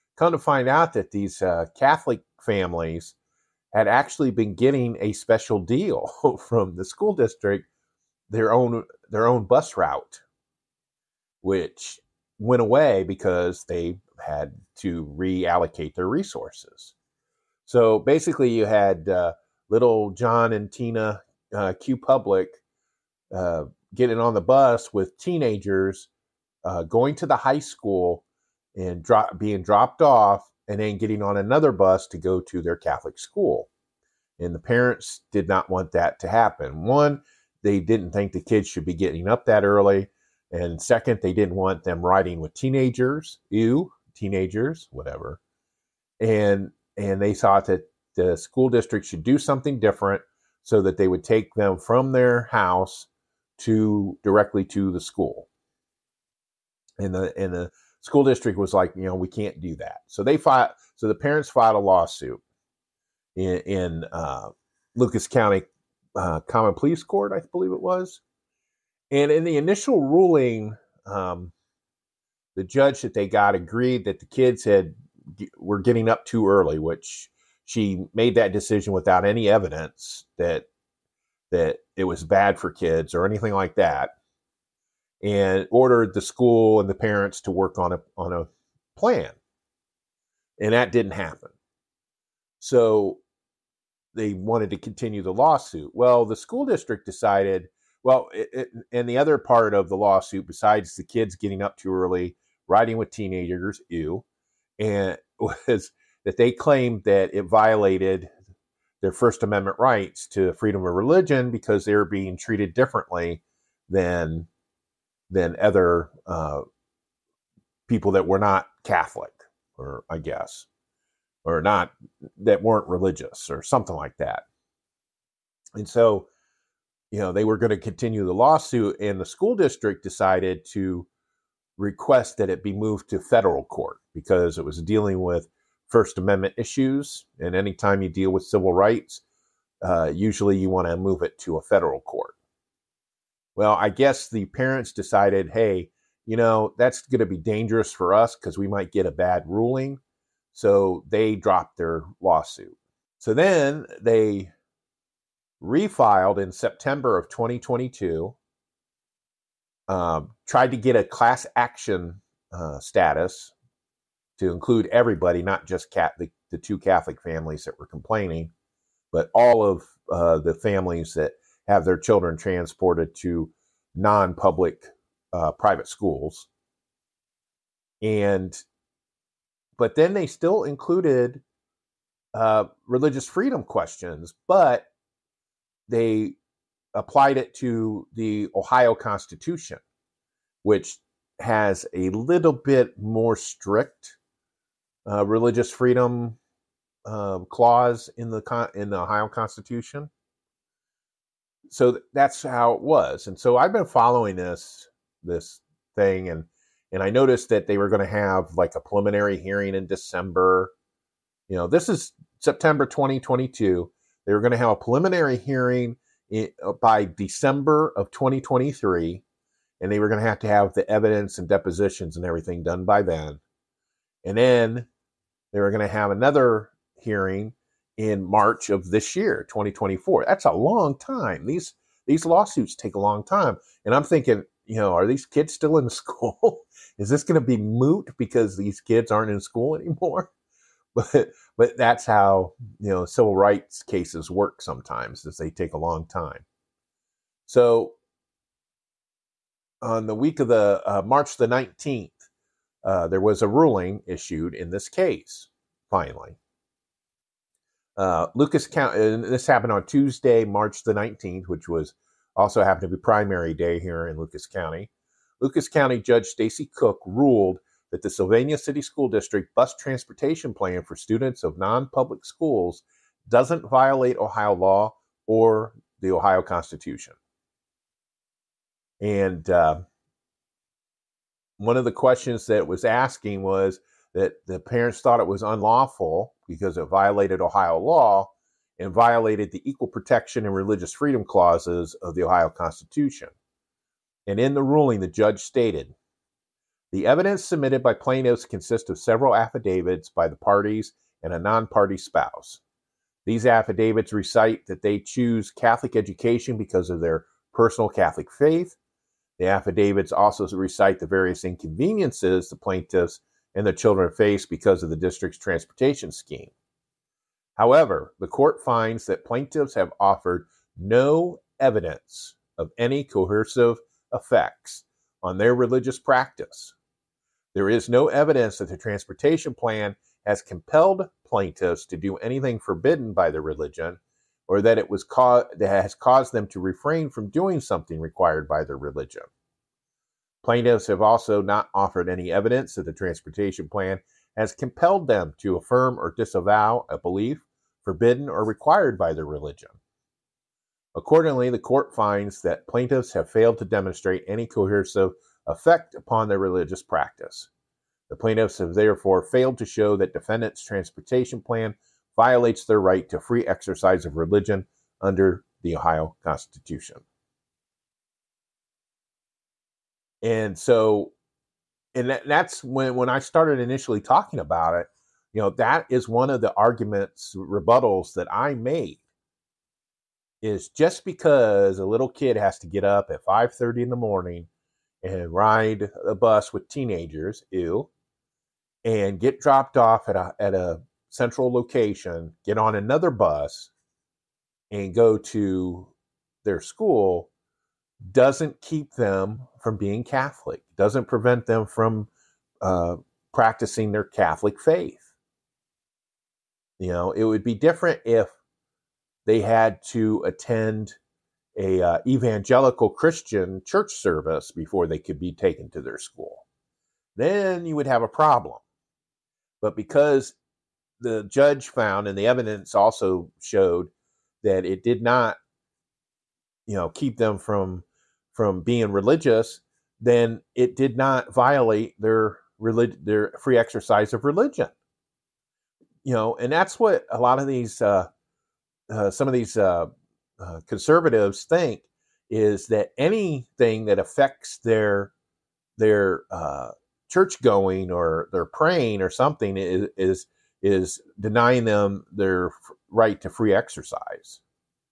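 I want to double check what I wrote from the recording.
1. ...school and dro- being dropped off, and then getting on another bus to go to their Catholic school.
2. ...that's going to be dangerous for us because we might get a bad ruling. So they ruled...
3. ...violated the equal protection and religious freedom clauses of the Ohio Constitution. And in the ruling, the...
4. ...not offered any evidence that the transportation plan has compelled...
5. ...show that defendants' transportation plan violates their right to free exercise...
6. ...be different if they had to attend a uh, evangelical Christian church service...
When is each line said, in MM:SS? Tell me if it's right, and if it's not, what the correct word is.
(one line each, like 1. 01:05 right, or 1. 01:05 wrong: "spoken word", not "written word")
1. 00:27 right
2. 02:26 wrong: "dropped", not "ruled"
3. 04:48 right
4. 05:41 right
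5. 05:59 right
6. 06:47 right.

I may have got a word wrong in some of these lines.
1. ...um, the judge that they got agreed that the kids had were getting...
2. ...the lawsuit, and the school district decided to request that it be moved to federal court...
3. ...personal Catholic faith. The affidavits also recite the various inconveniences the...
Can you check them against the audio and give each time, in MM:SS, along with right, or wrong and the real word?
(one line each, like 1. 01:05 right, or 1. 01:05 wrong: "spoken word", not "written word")
1. 01:11 right
2. 02:08 right
3. 05:07 right.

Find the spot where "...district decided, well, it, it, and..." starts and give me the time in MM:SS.
01:36.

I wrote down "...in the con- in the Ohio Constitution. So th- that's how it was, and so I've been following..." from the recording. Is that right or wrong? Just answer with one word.
right.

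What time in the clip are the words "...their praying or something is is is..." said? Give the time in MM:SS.
07:28.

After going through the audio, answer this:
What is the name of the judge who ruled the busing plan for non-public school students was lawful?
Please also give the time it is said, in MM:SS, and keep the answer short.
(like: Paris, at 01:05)
Stacy Cook, at 04:26.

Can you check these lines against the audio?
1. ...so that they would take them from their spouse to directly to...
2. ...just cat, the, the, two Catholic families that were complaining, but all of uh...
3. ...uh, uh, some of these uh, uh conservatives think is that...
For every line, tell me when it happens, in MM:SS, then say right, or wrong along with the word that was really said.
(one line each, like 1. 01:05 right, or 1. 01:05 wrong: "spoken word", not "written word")
1. 00:50 wrong: "house", not "spouse"
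2. 02:45 right
3. 07:17 right.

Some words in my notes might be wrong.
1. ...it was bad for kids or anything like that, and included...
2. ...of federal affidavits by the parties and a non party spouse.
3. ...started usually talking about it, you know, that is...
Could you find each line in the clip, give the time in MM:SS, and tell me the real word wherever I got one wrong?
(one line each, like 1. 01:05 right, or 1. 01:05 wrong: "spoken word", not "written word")
1. 01:21 wrong: "ordered", not "included"
2. 04:58 wrong: "several", not "federal"
3. 06:13 wrong: "initially", not "usually".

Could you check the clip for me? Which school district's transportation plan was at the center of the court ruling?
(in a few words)
Sylvania City School District.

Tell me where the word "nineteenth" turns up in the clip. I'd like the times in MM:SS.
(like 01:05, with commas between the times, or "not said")
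04:11, 04:20.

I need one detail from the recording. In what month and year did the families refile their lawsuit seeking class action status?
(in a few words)
September 2022.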